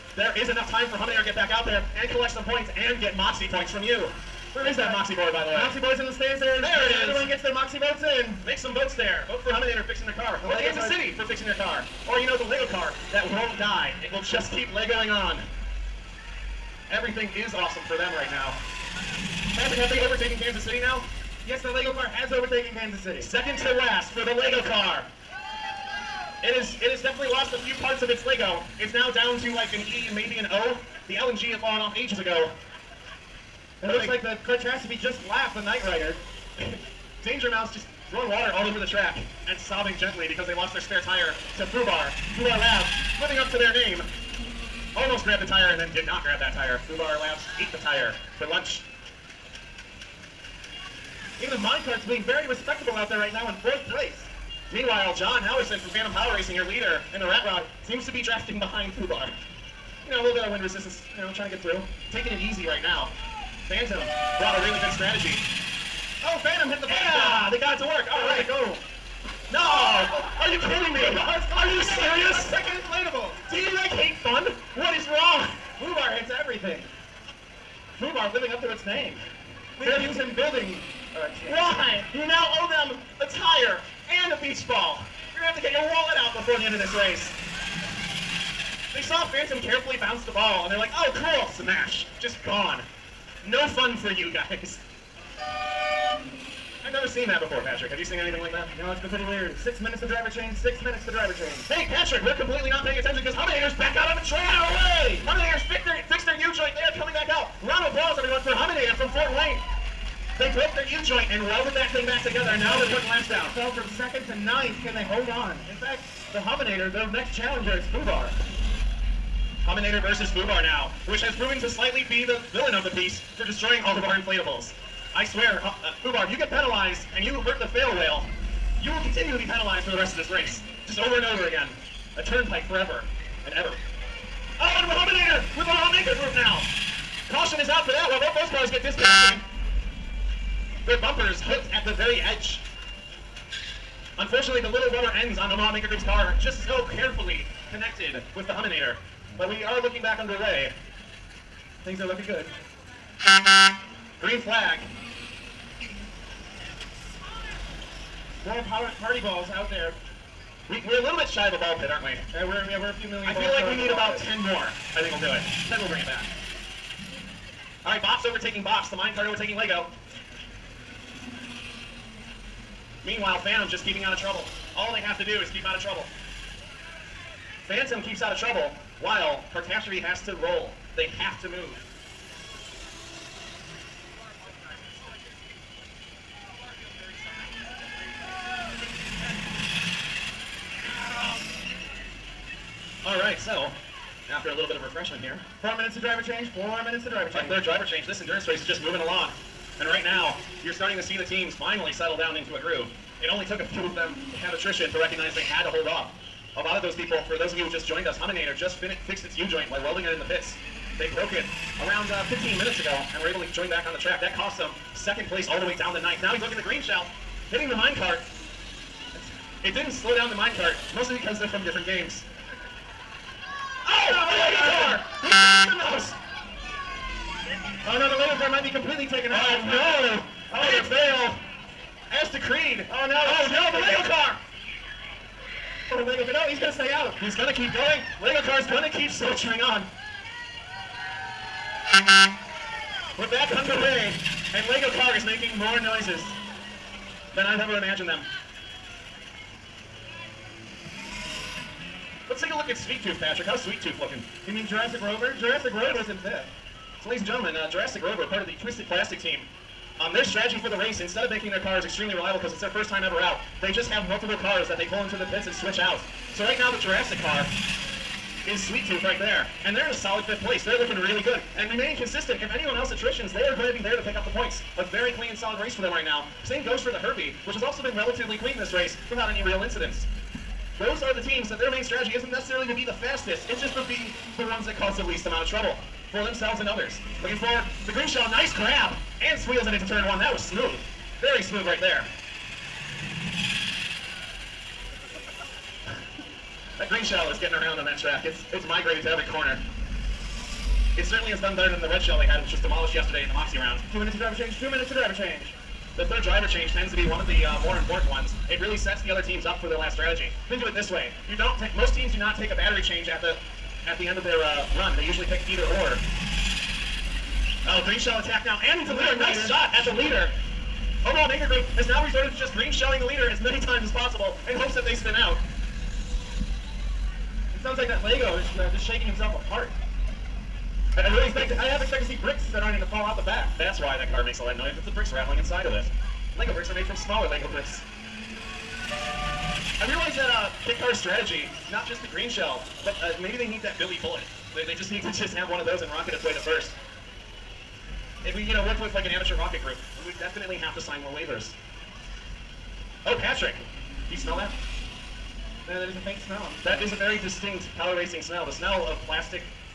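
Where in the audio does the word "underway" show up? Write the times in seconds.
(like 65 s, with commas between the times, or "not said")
150 s, 243 s.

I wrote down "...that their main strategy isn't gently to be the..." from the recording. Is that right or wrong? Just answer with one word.
wrong.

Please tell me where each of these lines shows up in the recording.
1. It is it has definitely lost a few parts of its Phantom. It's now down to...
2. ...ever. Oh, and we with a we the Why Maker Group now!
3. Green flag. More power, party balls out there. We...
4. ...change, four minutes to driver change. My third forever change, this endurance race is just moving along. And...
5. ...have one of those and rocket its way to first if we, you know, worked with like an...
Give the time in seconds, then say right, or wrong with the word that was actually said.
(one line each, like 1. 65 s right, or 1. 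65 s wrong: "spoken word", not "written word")
1. 26 s wrong: "Lego", not "Phantom"
2. 133 s wrong: "Omaha", not "Why"
3. 154 s right
4. 196 s wrong: "driver", not "forever"
5. 345 s right.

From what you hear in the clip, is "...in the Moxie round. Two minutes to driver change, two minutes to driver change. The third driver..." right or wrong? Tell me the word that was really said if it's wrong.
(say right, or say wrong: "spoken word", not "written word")
right.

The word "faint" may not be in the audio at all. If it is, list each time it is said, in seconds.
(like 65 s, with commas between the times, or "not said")
355 s.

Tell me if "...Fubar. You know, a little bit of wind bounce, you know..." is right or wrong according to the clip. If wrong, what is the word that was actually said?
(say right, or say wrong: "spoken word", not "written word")
wrong: "resistance", not "bounce".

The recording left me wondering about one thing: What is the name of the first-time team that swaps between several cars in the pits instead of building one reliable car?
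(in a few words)
Twisted Plastic.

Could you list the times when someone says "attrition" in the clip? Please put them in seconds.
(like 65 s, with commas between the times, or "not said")
204 s, 272 s.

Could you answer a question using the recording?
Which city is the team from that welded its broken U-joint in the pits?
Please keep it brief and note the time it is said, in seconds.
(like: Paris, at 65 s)
Fort Wayne, at 109 s.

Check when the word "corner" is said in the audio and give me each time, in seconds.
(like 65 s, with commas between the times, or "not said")
299 s.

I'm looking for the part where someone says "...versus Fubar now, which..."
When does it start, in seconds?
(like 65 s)
120 s.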